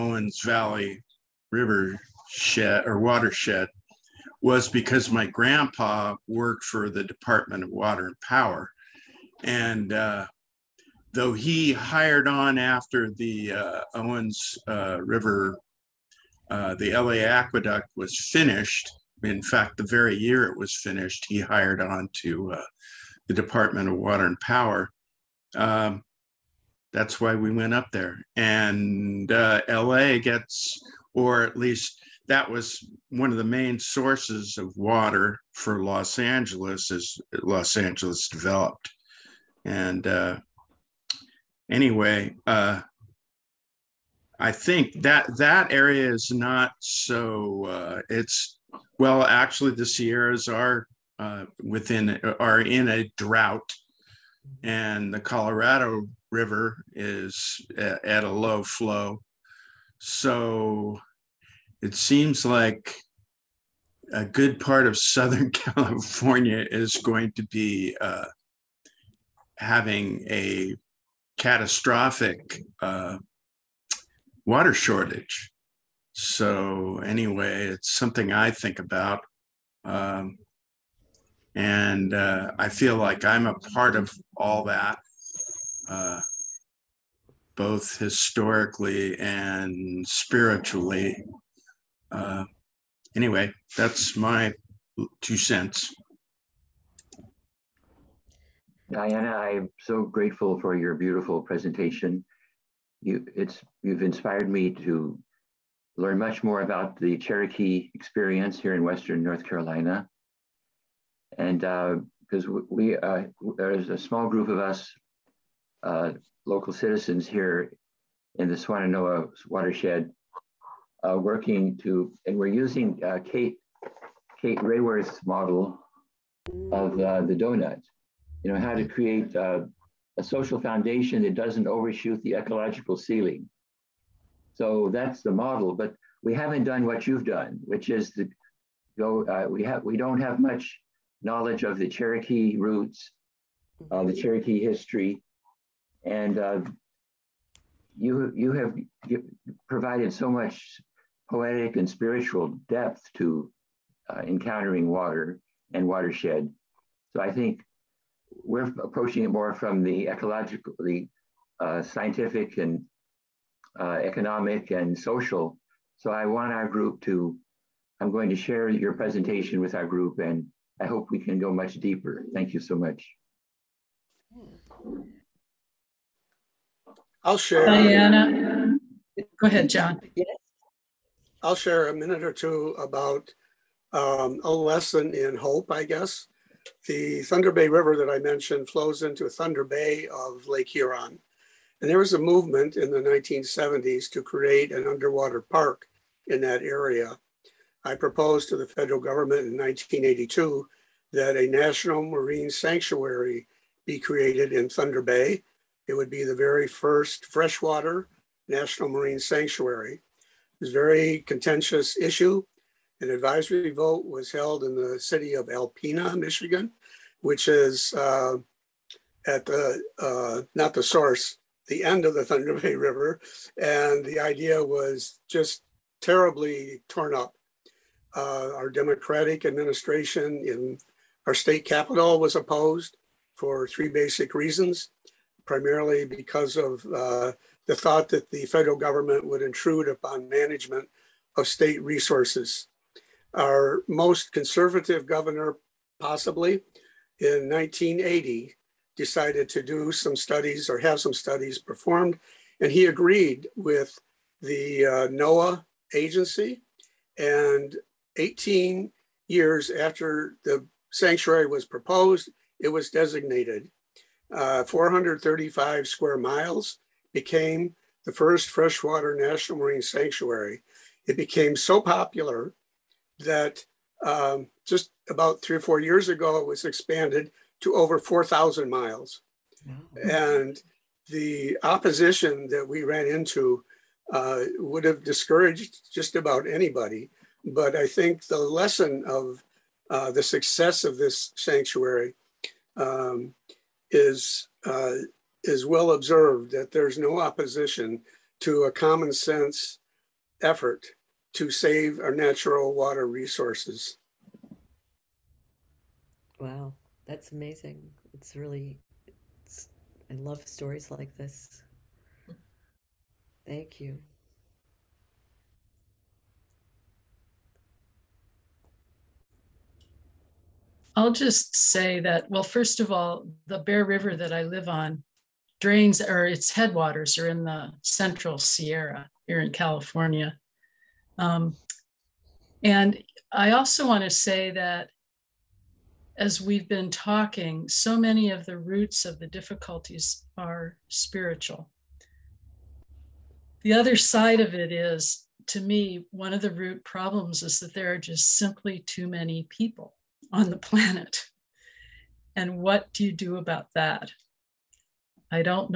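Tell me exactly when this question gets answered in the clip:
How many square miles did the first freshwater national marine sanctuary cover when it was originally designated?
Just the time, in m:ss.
4:24.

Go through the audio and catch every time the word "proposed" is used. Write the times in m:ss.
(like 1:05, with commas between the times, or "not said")
3:17, 4:21.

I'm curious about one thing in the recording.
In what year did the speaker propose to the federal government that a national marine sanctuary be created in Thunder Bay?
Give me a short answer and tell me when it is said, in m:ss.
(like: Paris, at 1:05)
1982, at 3:19.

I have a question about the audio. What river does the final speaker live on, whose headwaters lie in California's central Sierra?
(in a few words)
Bear River.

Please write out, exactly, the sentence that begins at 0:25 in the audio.
Um, that's why we went up there.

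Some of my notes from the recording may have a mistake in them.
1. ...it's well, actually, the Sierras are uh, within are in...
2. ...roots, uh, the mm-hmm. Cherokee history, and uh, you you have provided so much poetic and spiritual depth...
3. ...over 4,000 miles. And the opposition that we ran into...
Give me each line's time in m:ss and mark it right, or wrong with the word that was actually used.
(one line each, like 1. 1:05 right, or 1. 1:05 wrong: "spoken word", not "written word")
1. 0:48 right
2. 2:22 right
3. 4:37 right.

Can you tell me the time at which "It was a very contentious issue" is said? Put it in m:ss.
3:29.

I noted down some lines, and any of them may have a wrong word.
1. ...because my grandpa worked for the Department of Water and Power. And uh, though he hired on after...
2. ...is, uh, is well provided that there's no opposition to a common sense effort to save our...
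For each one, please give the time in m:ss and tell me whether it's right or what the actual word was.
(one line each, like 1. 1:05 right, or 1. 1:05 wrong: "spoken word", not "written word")
1. 0:04 right
2. 4:53 wrong: "observed", not "provided".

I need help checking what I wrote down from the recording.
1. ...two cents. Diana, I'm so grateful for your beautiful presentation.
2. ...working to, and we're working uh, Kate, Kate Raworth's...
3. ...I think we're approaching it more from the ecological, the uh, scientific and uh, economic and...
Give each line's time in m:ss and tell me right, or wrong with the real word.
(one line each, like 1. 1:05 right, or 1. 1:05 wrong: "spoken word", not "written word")
1. 1:35 right
2. 2:01 wrong: "using", not "working"
3. 2:37 right.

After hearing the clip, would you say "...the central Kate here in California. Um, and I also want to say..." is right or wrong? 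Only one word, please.
wrong.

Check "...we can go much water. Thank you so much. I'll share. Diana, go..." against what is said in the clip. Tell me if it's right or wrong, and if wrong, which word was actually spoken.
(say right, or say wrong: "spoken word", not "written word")
wrong: "deeper", not "water".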